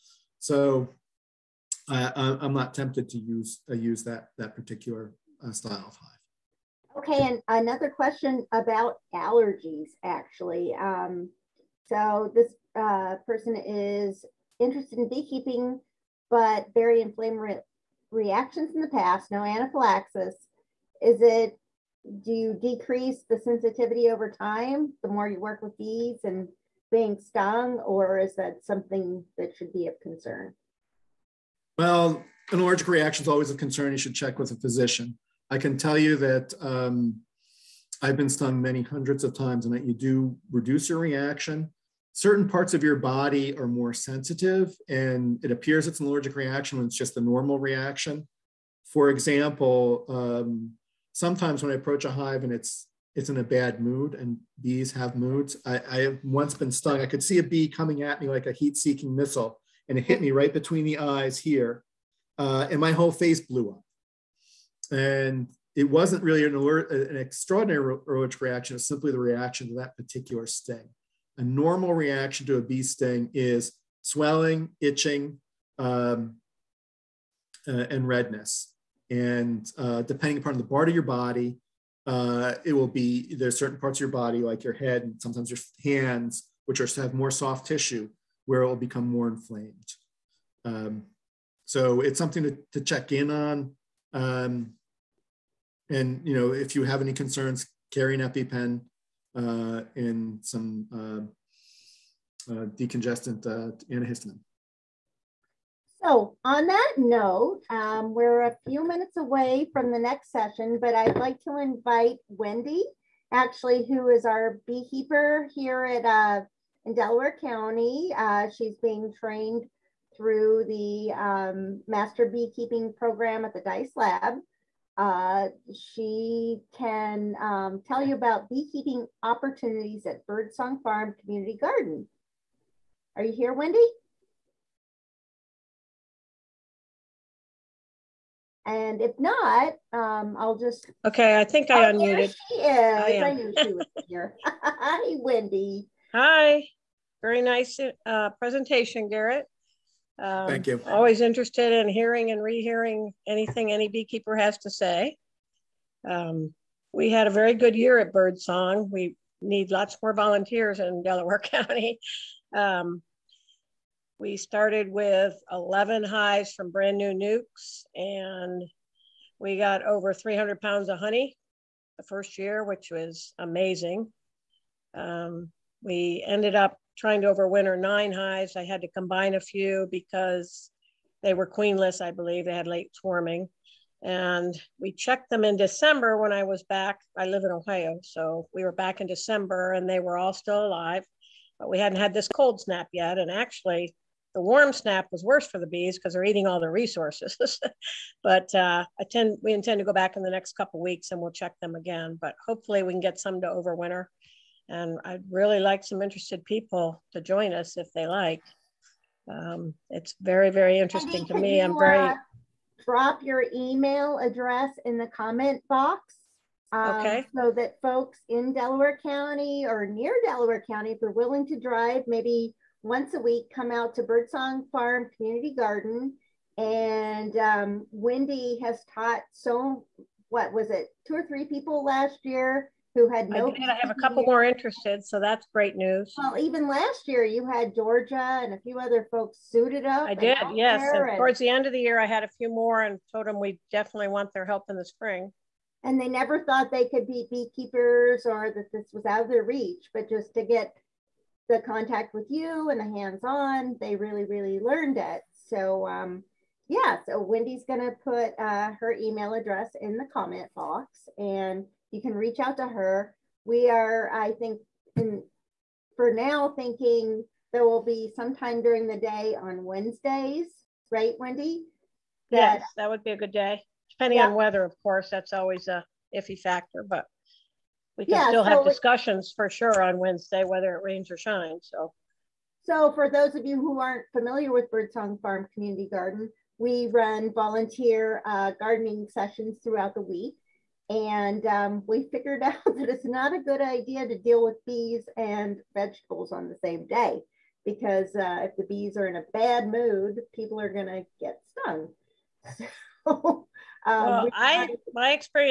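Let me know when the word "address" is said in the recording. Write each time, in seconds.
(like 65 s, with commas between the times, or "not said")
214 s, 259 s.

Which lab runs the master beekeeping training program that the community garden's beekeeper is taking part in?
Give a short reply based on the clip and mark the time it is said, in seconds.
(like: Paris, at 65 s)
Dyce lab, at 123 s.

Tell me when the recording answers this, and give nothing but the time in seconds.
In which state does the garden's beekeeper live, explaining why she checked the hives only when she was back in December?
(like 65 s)
187 s.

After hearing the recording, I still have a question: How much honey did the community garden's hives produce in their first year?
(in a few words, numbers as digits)
over 300 pounds.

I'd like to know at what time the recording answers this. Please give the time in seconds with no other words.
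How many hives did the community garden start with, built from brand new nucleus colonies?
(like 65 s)
165 s.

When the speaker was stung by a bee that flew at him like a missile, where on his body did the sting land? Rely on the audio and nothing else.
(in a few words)
between the eyes.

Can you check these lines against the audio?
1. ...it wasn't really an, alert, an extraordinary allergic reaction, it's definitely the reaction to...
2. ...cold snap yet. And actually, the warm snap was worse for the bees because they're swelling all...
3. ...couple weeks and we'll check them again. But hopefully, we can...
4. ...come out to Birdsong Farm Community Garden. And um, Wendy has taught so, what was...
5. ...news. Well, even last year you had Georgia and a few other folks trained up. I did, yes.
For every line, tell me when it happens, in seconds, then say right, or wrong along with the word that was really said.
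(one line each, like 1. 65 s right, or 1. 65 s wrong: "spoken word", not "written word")
1. 65 s wrong: "simply", not "definitely"
2. 192 s wrong: "eating", not "swelling"
3. 200 s right
4. 223 s right
5. 235 s wrong: "suited", not "trained".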